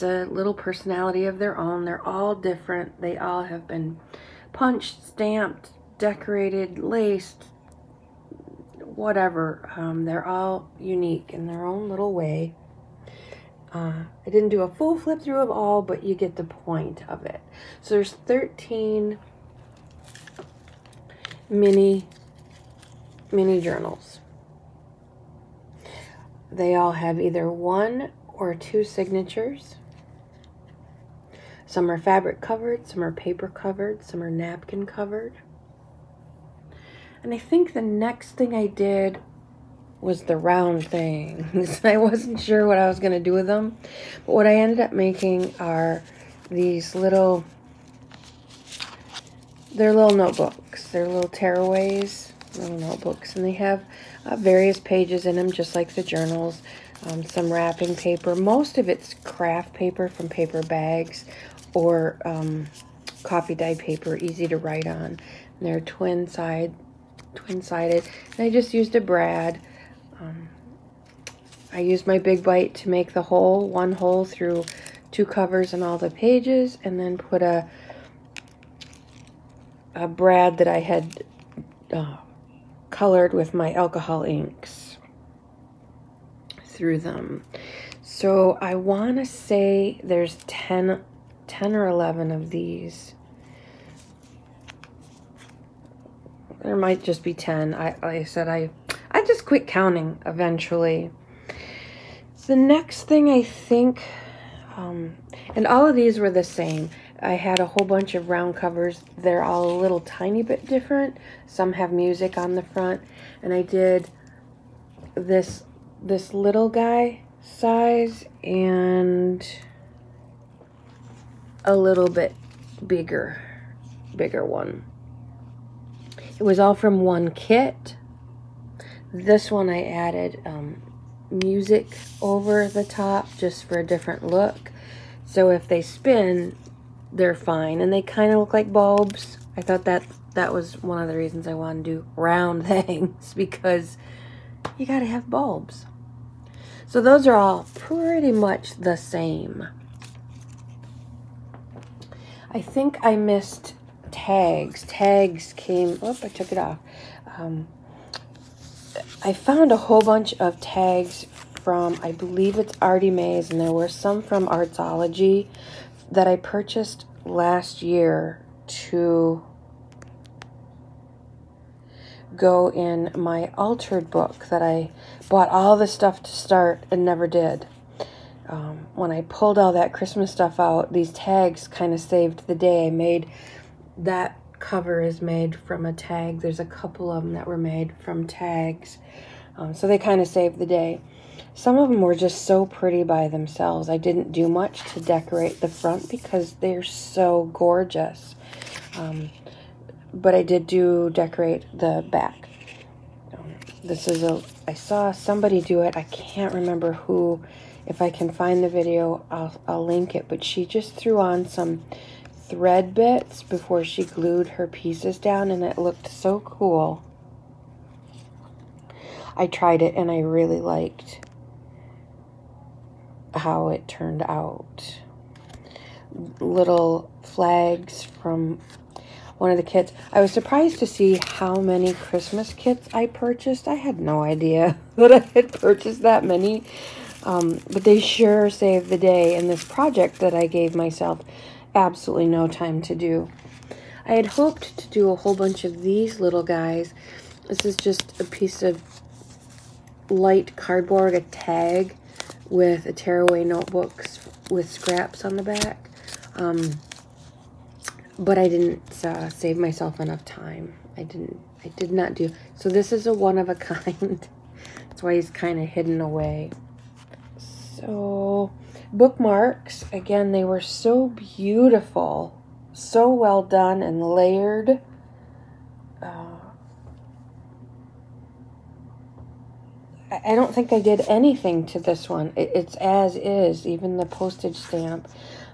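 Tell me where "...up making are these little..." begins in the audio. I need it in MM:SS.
00:44.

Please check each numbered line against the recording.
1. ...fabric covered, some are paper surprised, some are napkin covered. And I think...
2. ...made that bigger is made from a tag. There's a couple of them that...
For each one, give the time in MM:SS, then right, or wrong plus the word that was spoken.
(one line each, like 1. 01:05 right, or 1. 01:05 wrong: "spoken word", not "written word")
1. 00:31 wrong: "covered", not "surprised"
2. 03:02 wrong: "cover", not "bigger".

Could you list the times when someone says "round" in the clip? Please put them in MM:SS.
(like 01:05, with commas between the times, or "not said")
00:40, 01:48, 02:22.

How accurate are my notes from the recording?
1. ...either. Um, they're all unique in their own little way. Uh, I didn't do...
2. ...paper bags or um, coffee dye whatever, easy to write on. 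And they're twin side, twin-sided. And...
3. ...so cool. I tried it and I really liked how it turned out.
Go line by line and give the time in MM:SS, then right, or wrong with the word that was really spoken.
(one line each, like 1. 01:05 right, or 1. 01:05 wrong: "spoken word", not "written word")
1. 00:08 wrong: "whatever", not "either"
2. 01:00 wrong: "paper", not "whatever"
3. 03:36 right.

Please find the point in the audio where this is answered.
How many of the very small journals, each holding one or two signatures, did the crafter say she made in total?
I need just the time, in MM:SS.
00:18.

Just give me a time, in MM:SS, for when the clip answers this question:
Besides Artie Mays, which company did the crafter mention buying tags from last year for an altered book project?
02:44.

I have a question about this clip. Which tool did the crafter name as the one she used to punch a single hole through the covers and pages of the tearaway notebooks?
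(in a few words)
Big Bite.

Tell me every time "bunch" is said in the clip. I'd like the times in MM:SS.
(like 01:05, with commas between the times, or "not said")
01:47, 02:40, 04:05.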